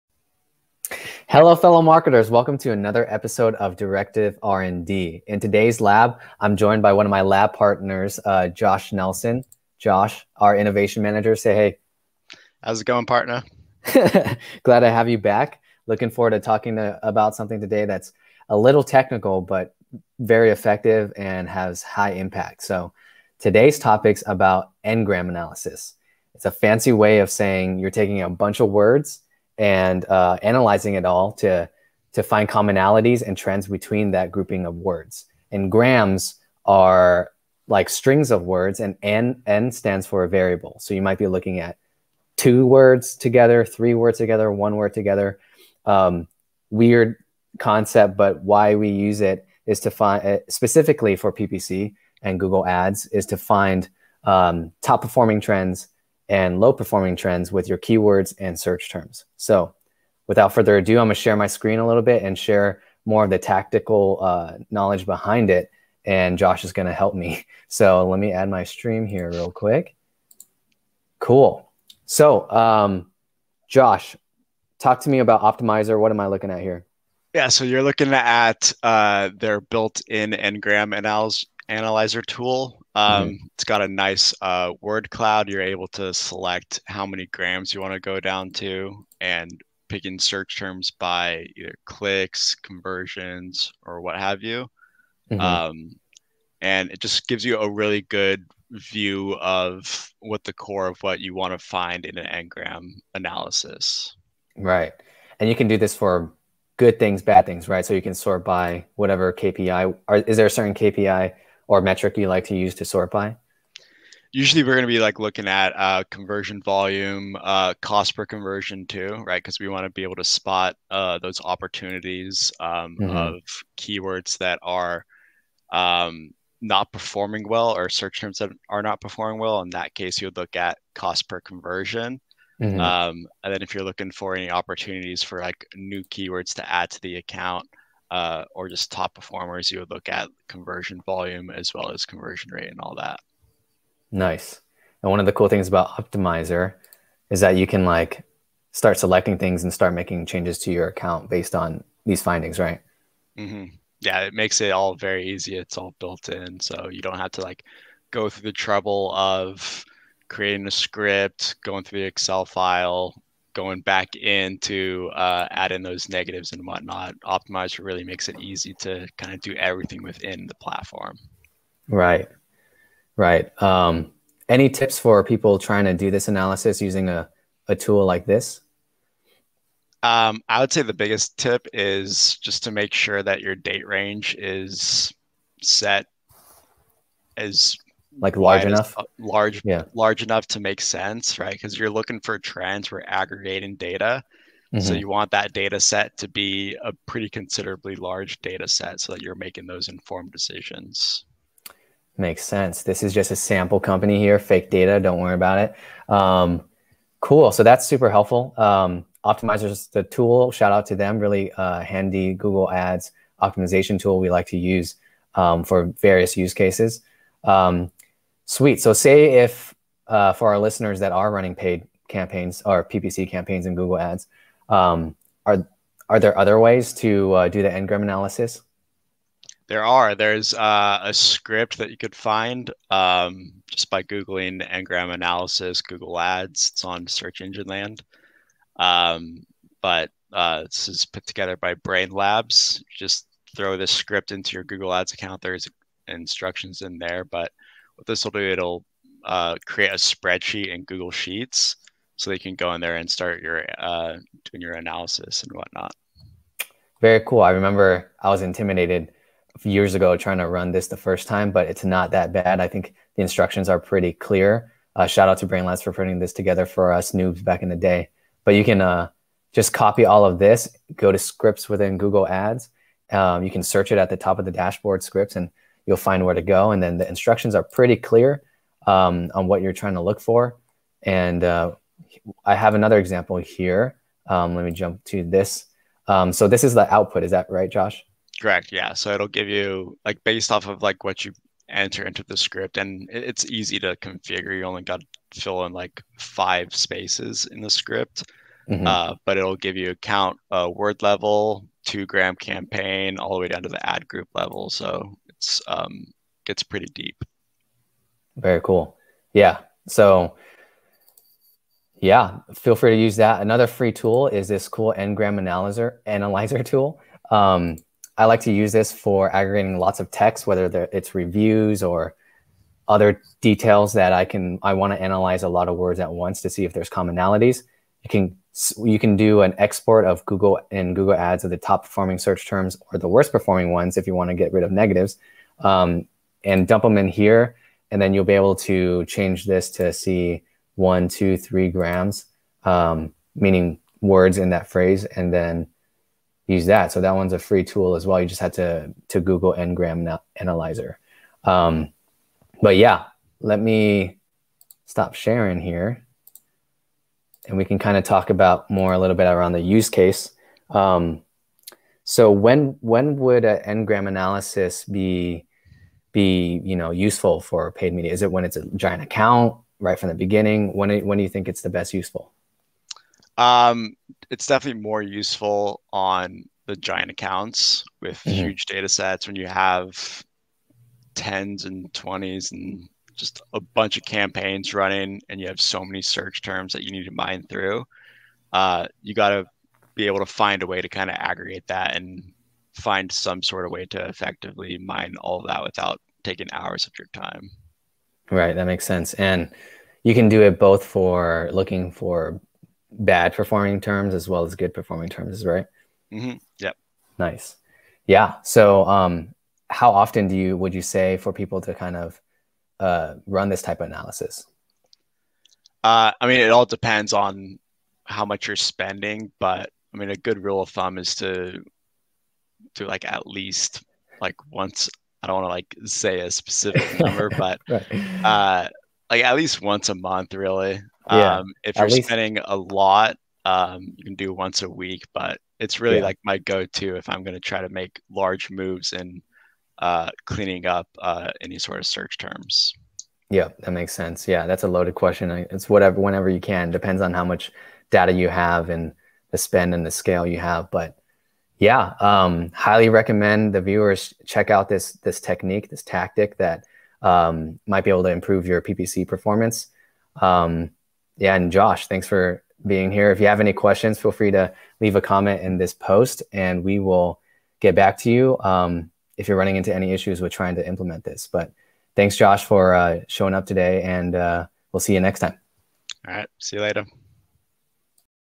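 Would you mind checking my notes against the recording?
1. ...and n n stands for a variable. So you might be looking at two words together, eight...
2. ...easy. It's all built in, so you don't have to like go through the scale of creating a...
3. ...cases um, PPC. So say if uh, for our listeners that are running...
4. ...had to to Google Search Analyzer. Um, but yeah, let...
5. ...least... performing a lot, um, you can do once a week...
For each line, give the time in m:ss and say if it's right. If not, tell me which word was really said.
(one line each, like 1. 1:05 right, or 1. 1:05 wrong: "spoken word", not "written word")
1. 0:38 wrong: "three", not "eight"
2. 2:35 wrong: "trouble", not "scale"
3. 3:36 wrong: "Sweet", not "PPC"
4. 5:48 wrong: "Ngram", not "Search"
5. 7:11 wrong: "spending", not "performing".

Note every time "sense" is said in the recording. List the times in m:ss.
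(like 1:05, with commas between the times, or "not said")
3:10, 3:22, 6:38, 7:23.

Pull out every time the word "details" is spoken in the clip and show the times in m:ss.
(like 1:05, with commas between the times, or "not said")
5:23.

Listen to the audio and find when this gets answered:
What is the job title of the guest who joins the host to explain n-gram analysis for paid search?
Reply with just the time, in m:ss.
0:10.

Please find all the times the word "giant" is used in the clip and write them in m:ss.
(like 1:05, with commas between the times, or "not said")
6:08, 6:16.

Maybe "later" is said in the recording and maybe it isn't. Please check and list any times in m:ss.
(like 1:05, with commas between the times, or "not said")
7:56.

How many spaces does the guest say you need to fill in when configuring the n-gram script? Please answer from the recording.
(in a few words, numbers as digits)
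5.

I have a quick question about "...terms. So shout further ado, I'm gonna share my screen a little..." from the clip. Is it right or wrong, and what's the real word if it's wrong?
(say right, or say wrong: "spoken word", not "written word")
wrong: "without", not "shout".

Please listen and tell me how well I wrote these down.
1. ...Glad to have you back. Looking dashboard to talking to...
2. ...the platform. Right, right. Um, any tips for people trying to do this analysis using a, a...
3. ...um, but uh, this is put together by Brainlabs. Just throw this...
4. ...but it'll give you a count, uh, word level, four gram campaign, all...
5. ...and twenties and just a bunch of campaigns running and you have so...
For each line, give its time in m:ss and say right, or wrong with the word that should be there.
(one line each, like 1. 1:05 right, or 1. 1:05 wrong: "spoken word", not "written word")
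1. 0:14 wrong: "forward", not "dashboard"
2. 2:50 right
3. 3:58 right
4. 4:59 wrong: "two", not "four"
5. 6:21 right.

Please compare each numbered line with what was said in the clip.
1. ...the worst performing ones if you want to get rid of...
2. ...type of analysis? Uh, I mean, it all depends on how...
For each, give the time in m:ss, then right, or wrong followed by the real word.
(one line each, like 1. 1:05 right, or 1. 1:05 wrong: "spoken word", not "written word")
1. 5:32 right
2. 6:53 right.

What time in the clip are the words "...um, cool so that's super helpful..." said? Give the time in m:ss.
3:26.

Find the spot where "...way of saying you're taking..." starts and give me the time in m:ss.
0:26.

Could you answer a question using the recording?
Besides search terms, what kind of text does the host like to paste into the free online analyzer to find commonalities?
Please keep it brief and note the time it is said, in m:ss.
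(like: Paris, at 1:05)
Reviews, at 5:21.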